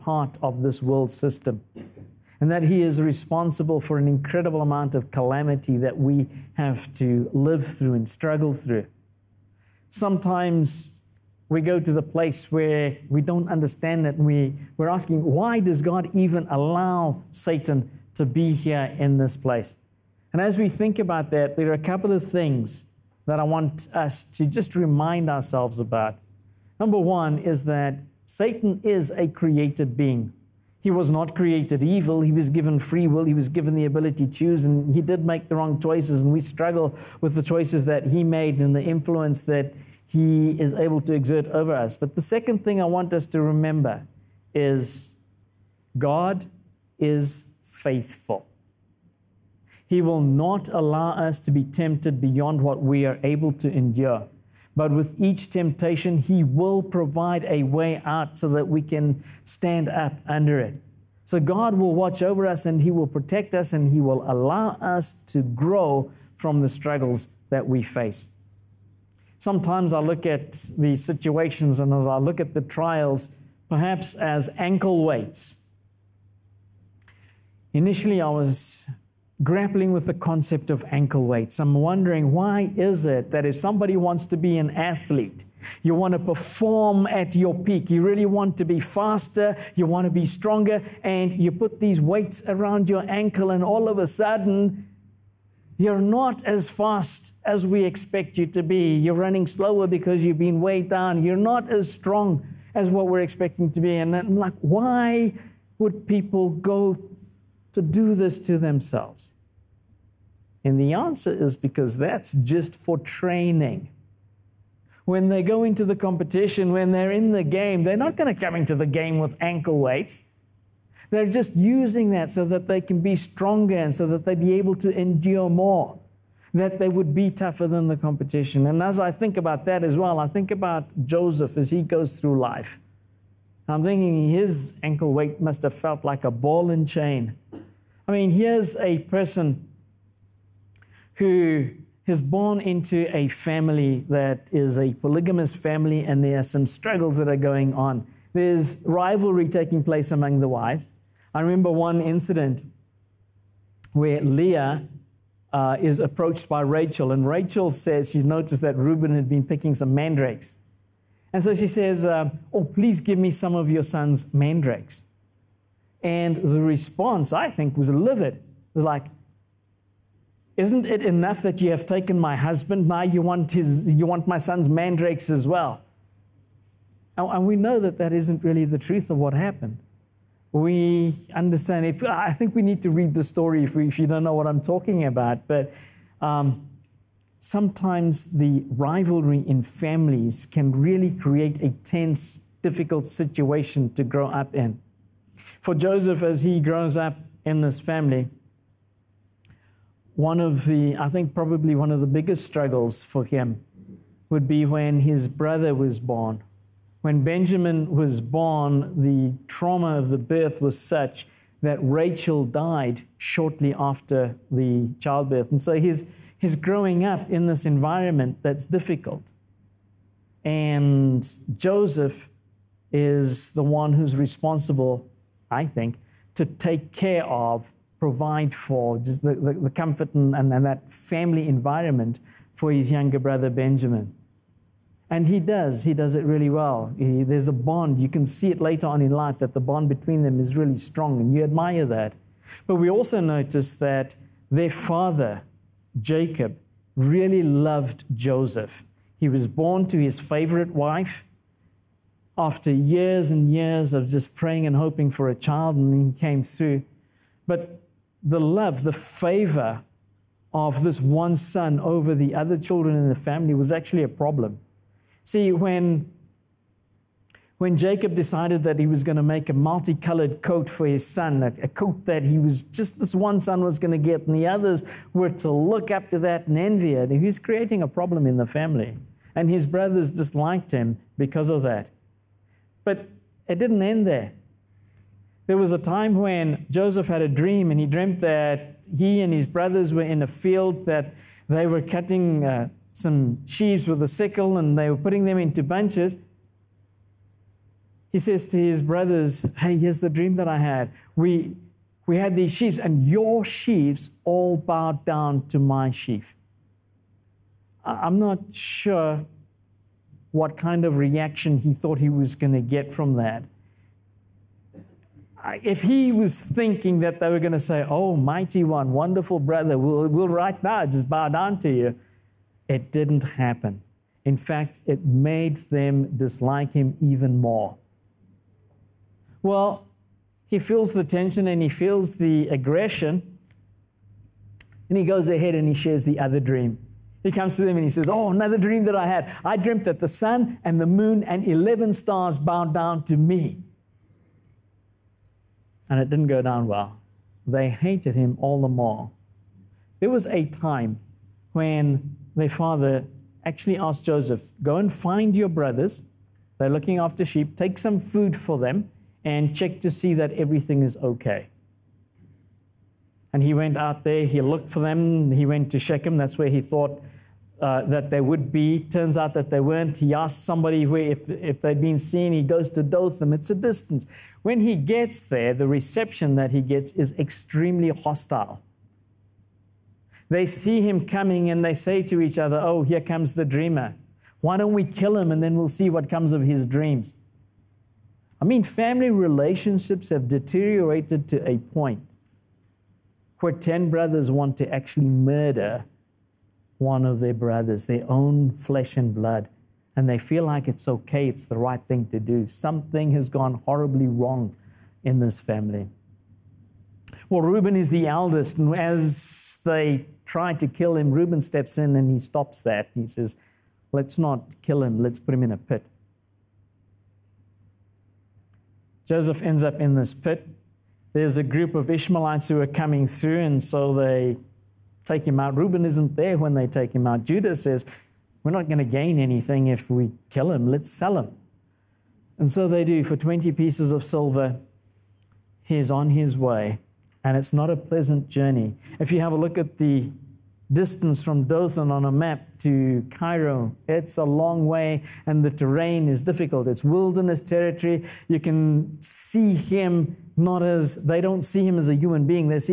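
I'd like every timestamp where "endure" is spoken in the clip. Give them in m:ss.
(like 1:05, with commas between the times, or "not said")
0:53, 2:04.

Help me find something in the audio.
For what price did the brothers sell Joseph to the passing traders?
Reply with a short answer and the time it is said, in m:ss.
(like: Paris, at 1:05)
20 pieces of silver, at 7:13.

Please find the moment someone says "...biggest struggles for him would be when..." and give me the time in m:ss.
3:22.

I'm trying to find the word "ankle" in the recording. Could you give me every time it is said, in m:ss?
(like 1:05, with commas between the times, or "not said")
1:14, 1:20, 1:33, 1:59, 2:14.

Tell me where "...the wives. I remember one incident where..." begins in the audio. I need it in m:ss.
2:30.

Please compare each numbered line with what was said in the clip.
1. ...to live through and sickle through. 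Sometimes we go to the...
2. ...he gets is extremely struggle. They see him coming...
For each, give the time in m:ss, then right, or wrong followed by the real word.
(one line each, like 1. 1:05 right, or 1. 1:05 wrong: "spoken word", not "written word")
1. 0:06 wrong: "struggle", not "sickle"
2. 6:16 wrong: "hostile", not "struggle".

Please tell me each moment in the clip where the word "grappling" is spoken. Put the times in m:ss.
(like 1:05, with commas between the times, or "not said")
1:19.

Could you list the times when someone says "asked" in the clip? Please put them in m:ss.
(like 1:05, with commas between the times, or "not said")
5:53, 6:10.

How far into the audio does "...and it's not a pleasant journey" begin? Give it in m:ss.
7:17.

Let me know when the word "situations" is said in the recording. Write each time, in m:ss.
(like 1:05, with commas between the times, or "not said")
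1:10, 3:13.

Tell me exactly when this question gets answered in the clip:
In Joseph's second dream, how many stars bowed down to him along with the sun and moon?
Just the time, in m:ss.
5:41.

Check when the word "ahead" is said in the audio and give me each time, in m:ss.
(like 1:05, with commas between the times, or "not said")
5:35.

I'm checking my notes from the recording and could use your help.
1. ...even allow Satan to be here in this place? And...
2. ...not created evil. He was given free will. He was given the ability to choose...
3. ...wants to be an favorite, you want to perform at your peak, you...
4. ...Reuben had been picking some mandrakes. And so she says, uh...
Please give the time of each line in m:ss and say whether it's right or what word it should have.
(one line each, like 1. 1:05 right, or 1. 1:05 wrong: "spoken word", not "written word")
1. 0:16 right
2. 0:31 right
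3. 1:23 wrong: "athlete", not "favorite"
4. 2:38 right.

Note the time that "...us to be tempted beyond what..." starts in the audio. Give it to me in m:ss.
0:51.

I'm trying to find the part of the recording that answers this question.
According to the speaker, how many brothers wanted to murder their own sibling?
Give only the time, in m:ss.
6:33.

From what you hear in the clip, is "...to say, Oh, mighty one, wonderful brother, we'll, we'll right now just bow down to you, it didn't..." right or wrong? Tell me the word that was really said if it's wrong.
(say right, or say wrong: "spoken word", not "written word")
right.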